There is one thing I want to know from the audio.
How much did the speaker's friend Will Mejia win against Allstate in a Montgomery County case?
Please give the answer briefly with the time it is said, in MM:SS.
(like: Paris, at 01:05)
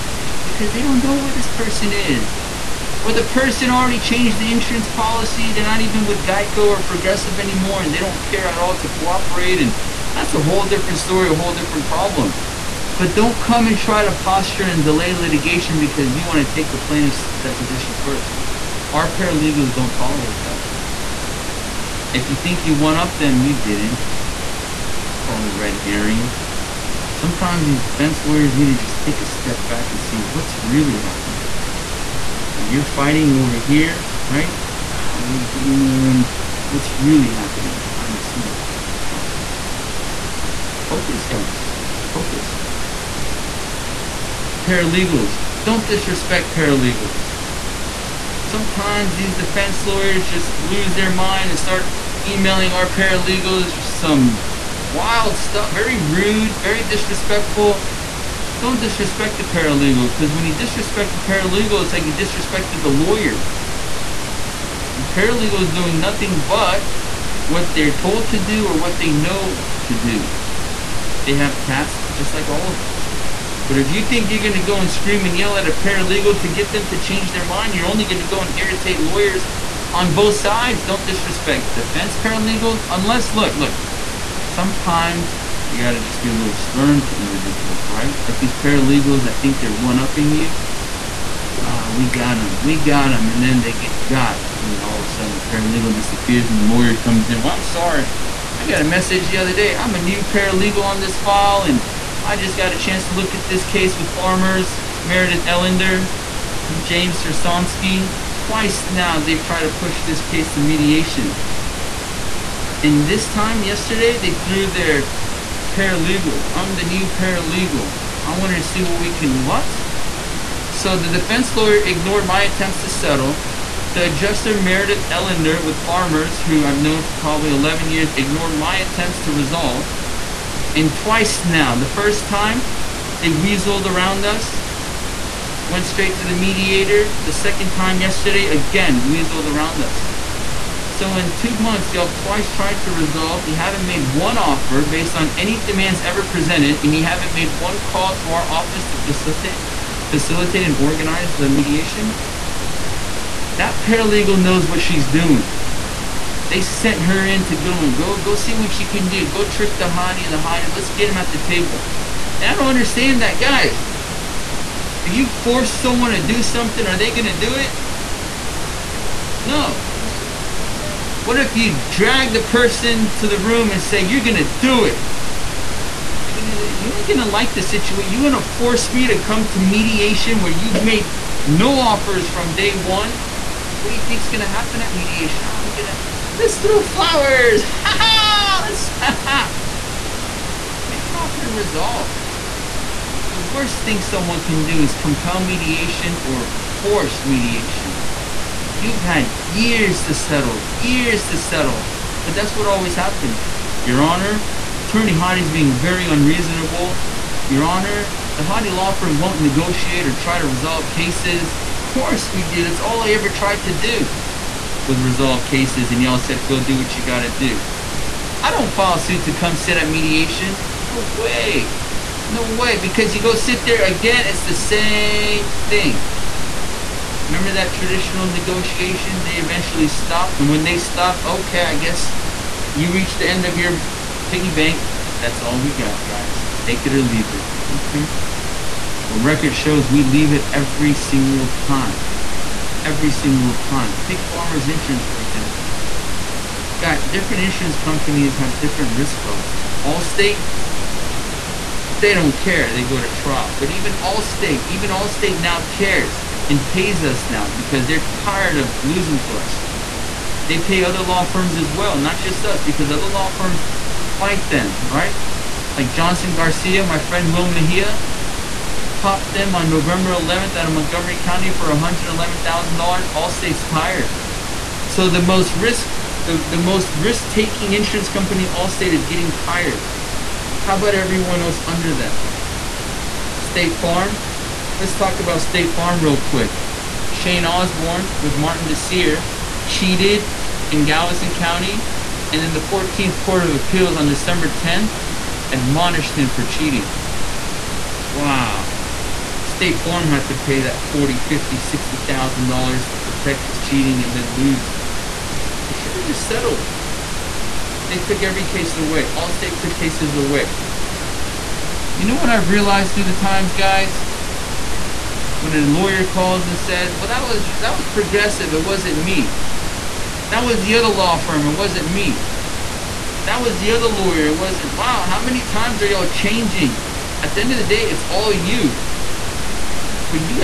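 $111,000, at 04:31.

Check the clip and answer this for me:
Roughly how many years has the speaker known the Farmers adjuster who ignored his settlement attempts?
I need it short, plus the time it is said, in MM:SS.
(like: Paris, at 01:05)
11, at 02:07.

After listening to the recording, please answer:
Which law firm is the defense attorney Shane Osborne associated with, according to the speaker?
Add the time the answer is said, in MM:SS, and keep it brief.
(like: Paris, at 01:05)
Martin Disiere, at 04:48.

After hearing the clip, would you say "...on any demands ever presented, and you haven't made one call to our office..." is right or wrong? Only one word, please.
right.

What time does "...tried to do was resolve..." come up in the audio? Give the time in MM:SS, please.
03:33.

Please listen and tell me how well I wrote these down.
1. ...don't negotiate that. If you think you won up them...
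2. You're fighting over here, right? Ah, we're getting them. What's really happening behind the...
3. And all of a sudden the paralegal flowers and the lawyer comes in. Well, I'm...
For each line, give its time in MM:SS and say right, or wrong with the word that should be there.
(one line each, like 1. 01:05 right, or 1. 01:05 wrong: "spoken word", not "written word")
1. 00:19 wrong: "tolerate", not "negotiate"
2. 00:32 right
3. 01:34 wrong: "disappears", not "flowers".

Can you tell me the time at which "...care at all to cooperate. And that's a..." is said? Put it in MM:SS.
00:08.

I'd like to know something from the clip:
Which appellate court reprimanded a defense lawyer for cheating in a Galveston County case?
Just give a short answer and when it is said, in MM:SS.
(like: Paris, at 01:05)
14th Court of Appeals, at 04:52.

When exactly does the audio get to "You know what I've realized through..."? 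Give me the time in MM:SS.
05:11.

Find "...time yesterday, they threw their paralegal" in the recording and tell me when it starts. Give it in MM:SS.
01:53.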